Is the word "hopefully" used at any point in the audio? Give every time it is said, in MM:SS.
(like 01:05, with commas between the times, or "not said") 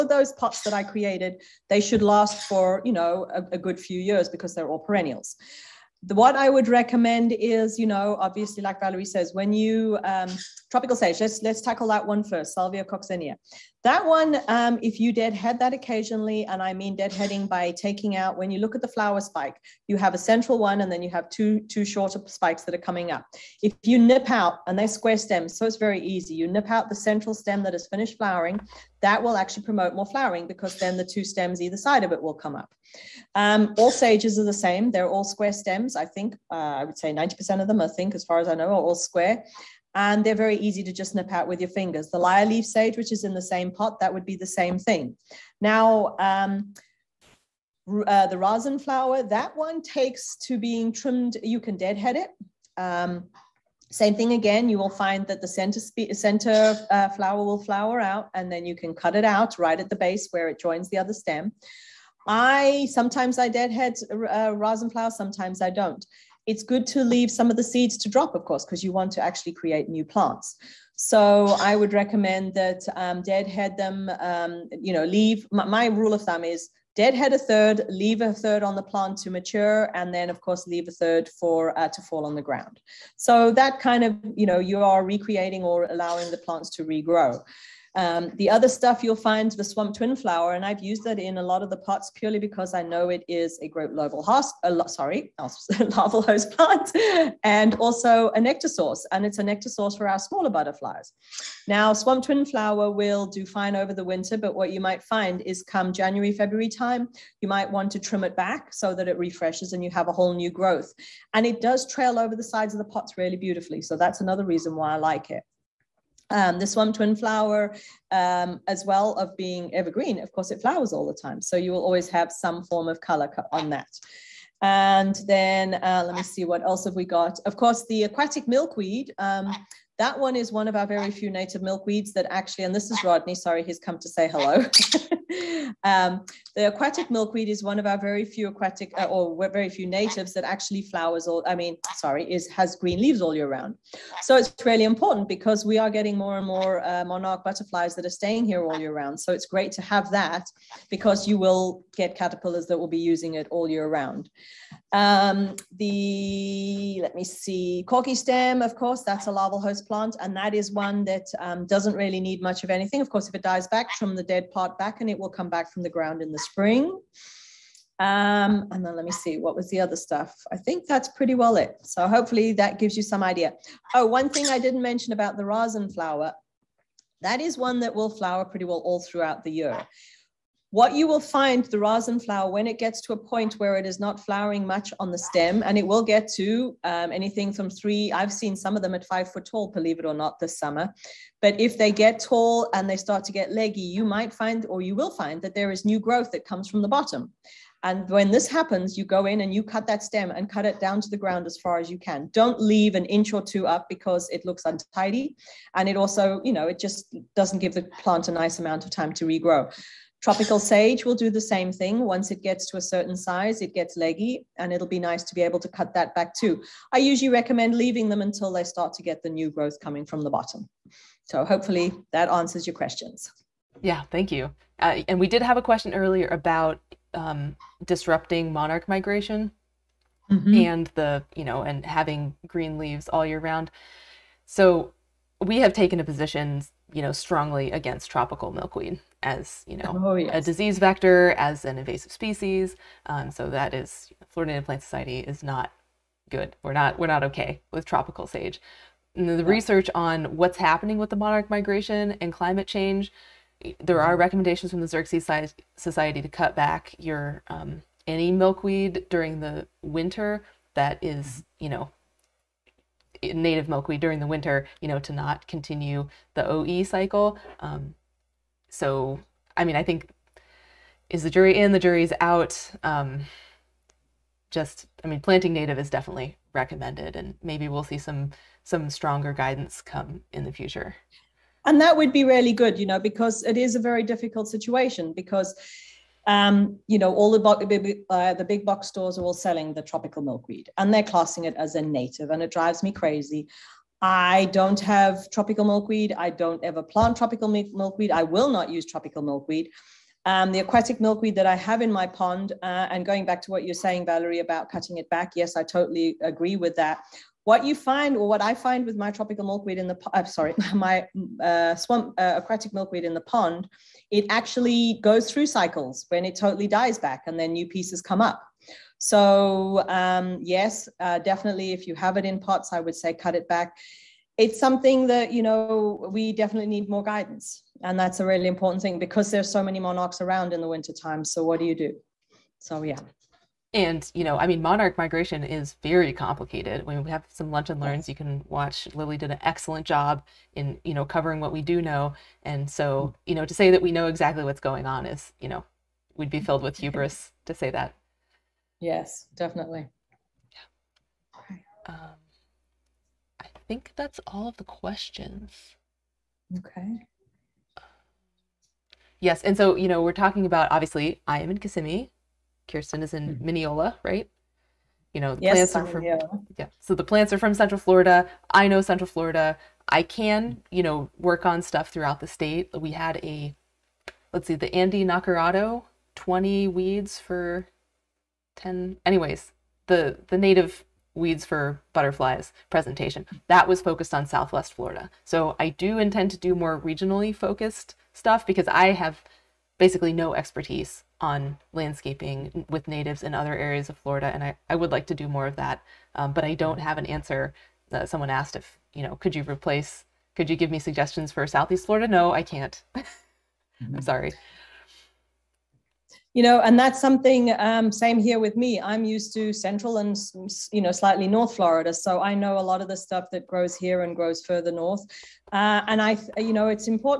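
02:52, 03:41.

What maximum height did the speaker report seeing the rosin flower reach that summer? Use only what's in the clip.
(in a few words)
5 feet.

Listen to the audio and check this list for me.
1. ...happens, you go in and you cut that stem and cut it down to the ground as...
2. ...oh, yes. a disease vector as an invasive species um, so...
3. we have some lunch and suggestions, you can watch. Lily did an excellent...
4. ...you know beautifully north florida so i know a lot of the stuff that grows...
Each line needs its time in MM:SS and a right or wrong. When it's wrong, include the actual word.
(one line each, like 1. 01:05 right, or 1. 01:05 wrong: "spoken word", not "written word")
1. 03:18 right
2. 04:00 right
3. 05:36 wrong: "learns", not "suggestions"
4. 06:50 wrong: "slightly", not "beautifully".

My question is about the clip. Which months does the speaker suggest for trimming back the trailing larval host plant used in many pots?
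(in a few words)
January, February.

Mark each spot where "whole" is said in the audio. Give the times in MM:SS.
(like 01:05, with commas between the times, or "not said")
01:50.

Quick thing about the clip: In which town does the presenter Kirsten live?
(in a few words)
Minneola.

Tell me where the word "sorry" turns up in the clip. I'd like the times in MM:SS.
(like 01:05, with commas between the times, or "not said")
01:34, 02:13, 02:21, 05:10, 06:44.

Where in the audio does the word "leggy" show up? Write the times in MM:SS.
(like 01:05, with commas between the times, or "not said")
03:13, 03:33.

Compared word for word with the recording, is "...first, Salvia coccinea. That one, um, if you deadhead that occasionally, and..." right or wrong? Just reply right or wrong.
right.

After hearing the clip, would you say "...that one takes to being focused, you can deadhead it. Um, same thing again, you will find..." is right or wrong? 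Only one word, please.
wrong.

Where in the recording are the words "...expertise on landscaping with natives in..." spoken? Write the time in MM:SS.
06:30.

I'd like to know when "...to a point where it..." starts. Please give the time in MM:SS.
03:03.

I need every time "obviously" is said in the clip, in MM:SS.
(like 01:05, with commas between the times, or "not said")
00:08, 06:00.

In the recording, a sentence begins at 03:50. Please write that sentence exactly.
and the, you know, and having green leaves all year round.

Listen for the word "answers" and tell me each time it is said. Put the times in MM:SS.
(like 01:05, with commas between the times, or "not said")
03:42, 06:37.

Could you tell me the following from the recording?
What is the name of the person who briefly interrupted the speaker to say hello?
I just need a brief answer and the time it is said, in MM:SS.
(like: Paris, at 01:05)
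Rodney, at 02:13.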